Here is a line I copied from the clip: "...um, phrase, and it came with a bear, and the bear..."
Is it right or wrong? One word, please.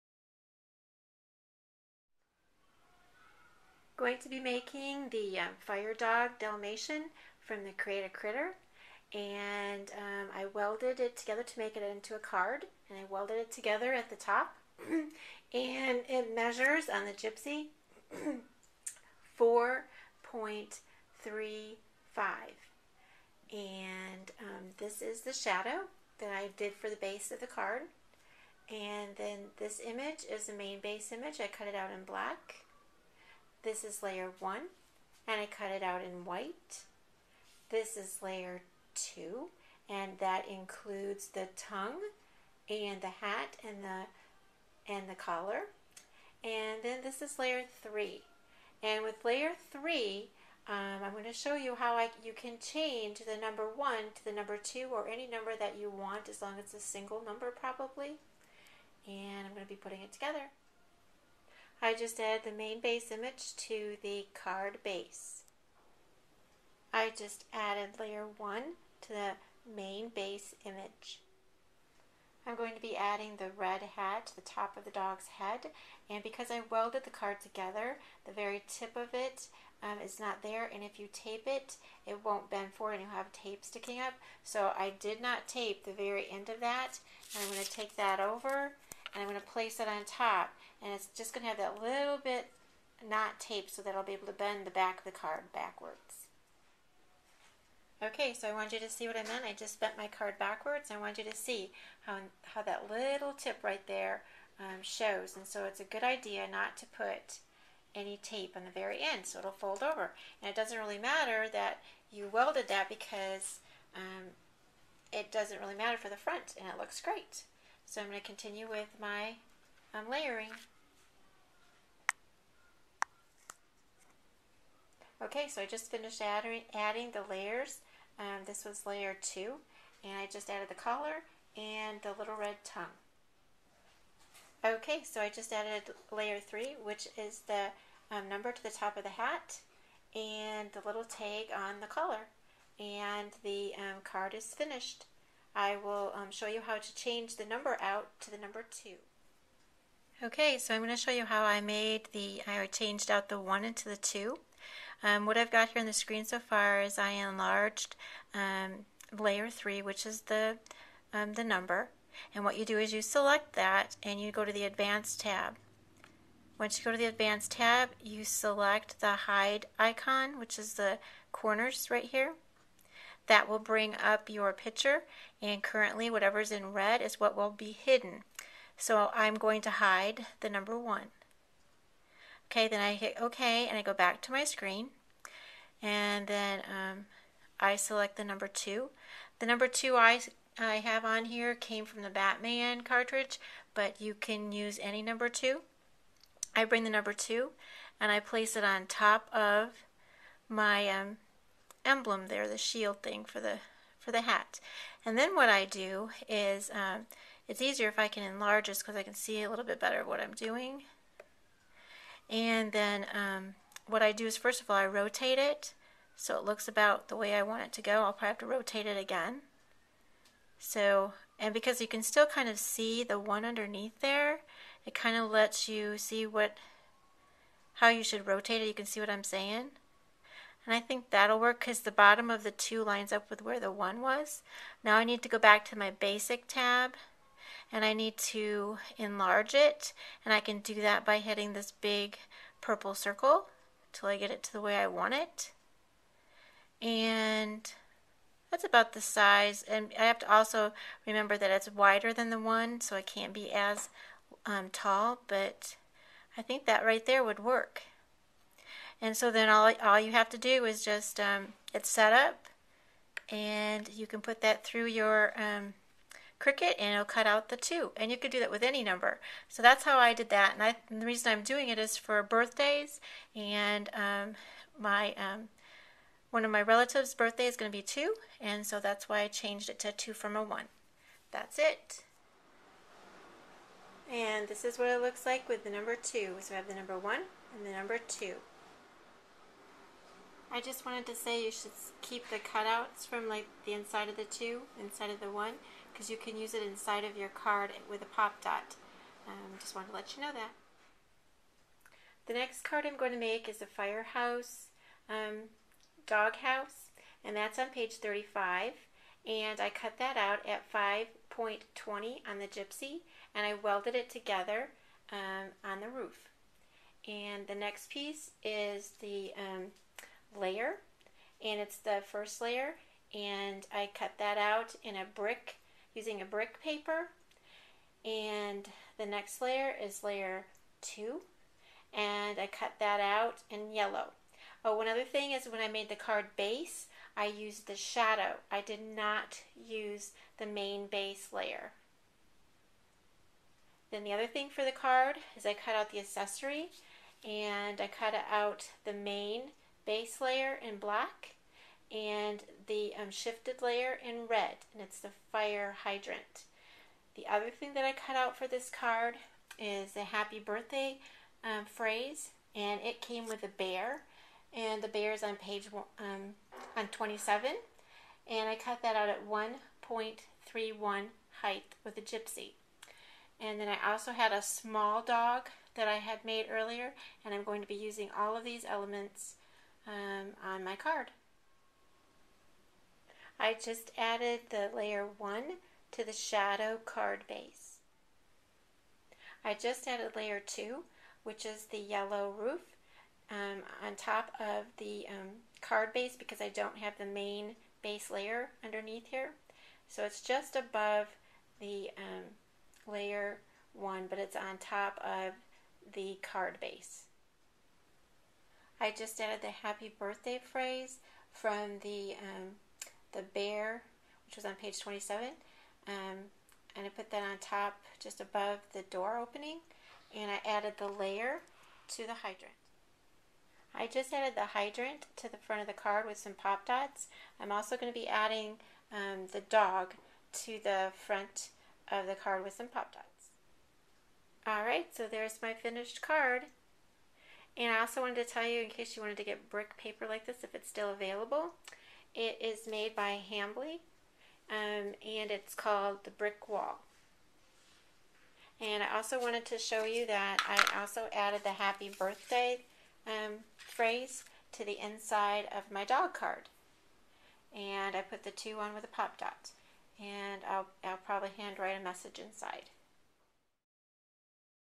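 right.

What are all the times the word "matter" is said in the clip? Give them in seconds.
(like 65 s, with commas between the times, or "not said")
110 s, 115 s.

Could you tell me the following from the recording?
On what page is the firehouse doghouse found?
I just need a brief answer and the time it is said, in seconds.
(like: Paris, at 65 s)
35, at 307 s.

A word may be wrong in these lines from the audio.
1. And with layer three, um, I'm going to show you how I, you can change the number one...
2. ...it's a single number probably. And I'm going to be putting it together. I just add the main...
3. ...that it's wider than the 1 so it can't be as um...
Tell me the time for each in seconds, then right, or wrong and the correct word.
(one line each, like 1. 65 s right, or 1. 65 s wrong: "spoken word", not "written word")
1. 48 s right
2. 56 s right
3. 251 s right.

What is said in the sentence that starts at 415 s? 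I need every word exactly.
Um, and I put that on top just above the door opening.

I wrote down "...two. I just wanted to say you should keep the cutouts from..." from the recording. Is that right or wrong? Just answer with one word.
right.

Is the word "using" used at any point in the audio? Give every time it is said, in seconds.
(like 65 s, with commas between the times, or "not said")
325 s, 377 s.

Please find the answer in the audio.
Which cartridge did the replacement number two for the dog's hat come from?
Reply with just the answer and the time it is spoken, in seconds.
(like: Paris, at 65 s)
Batman, at 192 s.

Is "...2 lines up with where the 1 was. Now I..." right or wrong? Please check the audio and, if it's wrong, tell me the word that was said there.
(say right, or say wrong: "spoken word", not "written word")
right.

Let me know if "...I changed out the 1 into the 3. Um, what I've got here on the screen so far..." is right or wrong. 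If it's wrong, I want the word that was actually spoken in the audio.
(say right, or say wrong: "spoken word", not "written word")
wrong: "2", not "3".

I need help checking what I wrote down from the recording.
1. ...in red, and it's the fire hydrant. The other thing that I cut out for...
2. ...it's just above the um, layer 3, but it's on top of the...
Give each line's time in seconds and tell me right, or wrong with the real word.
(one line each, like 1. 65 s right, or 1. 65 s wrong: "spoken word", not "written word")
1. 354 s right
2. 400 s wrong: "1", not "3".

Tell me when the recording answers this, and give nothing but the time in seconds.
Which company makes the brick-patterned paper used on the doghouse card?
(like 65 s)
443 s.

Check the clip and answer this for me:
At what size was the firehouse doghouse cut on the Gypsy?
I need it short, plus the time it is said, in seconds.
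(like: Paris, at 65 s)
5.20, at 310 s.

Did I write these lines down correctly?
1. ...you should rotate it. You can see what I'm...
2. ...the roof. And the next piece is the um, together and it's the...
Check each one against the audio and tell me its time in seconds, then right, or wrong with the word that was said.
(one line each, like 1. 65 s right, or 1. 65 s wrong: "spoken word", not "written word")
1. 227 s right
2. 315 s wrong: "layer", not "together".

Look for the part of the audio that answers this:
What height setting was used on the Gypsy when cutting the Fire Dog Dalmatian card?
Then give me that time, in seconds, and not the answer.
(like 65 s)
19 s.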